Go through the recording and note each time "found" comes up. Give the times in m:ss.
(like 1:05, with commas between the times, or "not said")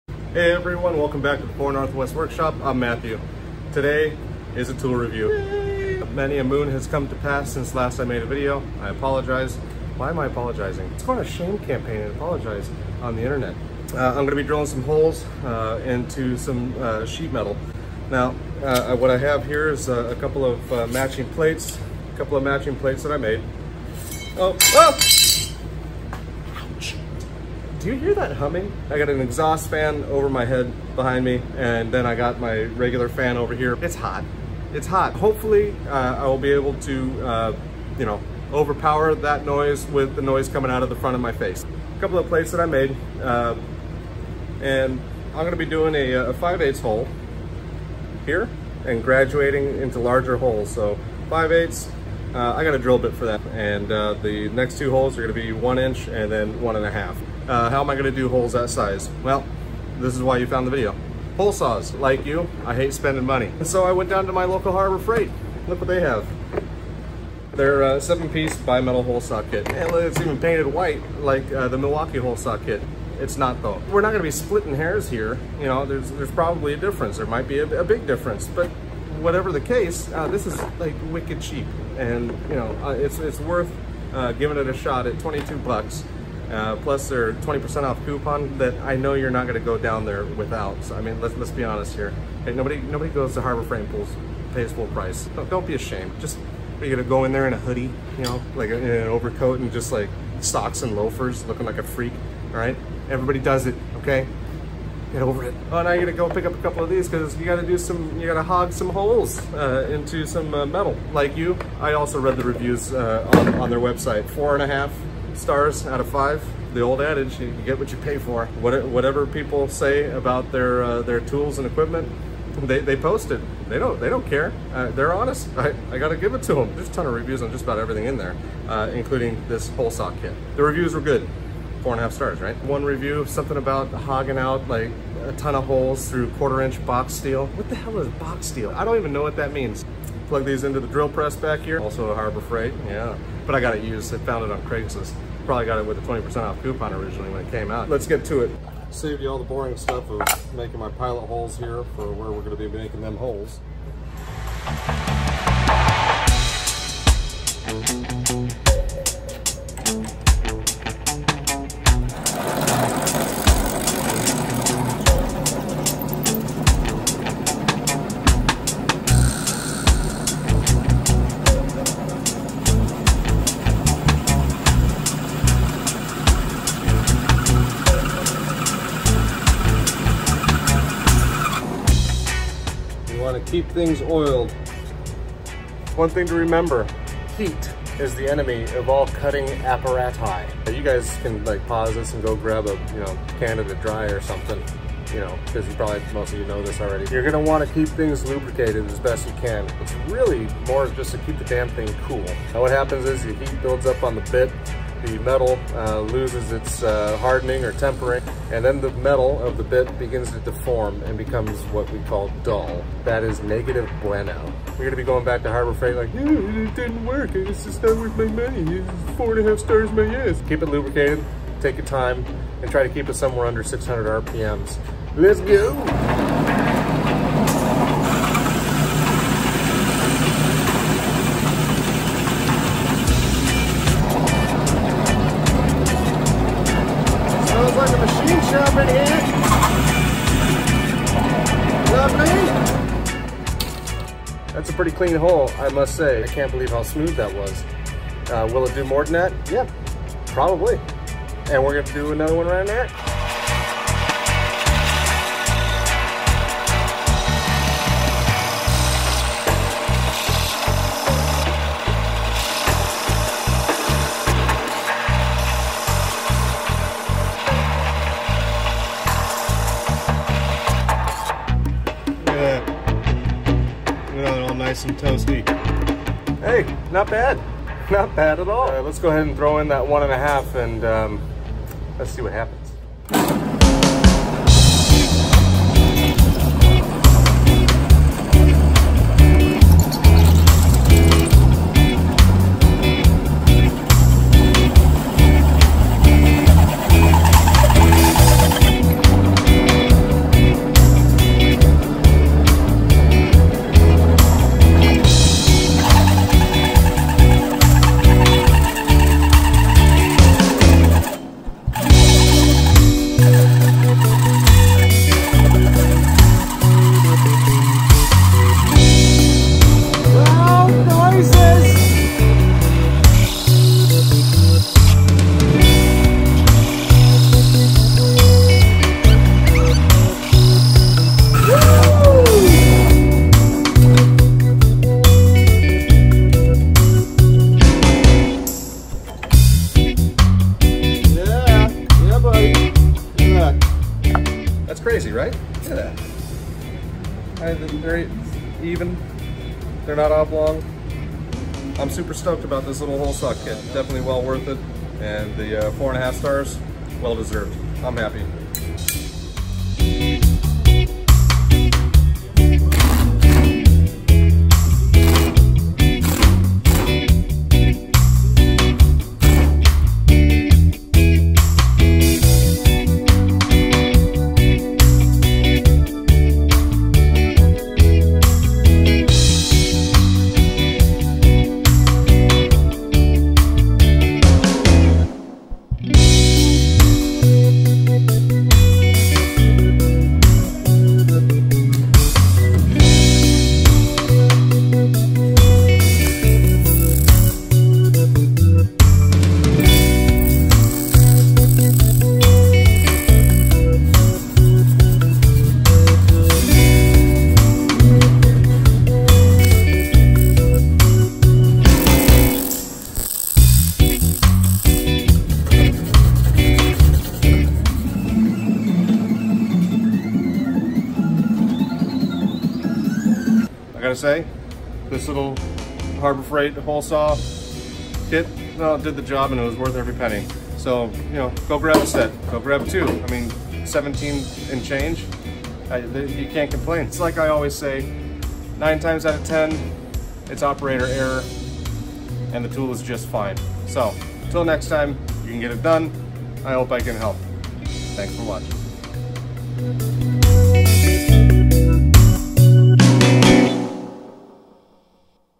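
1:00, 2:24.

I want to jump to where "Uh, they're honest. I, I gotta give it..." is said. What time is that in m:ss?
2:04.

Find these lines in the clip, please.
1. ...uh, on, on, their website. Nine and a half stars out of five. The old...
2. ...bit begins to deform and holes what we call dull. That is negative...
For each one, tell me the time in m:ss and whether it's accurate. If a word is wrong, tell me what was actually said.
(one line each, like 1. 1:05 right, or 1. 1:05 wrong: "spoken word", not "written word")
1. 1:52 wrong: "Four", not "Nine"
2. 3:29 wrong: "becomes", not "holes".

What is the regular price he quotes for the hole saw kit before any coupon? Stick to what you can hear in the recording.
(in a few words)
$22.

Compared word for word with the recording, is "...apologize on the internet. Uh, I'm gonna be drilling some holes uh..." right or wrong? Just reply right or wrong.
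right.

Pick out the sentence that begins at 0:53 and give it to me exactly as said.
And uh, the next two holes are gonna be one inch and then one and a half.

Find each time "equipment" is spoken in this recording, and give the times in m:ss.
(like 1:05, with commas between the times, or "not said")
2:01.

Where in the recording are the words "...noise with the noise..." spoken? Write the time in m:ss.
0:39.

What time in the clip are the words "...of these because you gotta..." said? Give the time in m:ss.
1:46.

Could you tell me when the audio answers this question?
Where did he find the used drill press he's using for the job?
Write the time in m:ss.
2:24.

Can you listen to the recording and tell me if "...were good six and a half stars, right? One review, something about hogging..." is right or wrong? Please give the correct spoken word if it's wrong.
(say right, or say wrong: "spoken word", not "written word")
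wrong: "four", not "six".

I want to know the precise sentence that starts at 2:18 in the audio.
I don't even know what that means.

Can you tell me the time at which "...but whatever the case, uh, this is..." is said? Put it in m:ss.
1:18.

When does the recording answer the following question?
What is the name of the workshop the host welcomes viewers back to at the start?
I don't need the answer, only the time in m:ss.
0:01.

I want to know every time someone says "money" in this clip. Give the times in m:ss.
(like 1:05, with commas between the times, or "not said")
1:03, 3:38.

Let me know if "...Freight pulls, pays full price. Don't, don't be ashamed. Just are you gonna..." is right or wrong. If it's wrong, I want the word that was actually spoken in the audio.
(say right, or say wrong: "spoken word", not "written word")
right.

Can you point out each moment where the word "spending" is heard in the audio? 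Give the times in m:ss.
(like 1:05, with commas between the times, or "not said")
1:02.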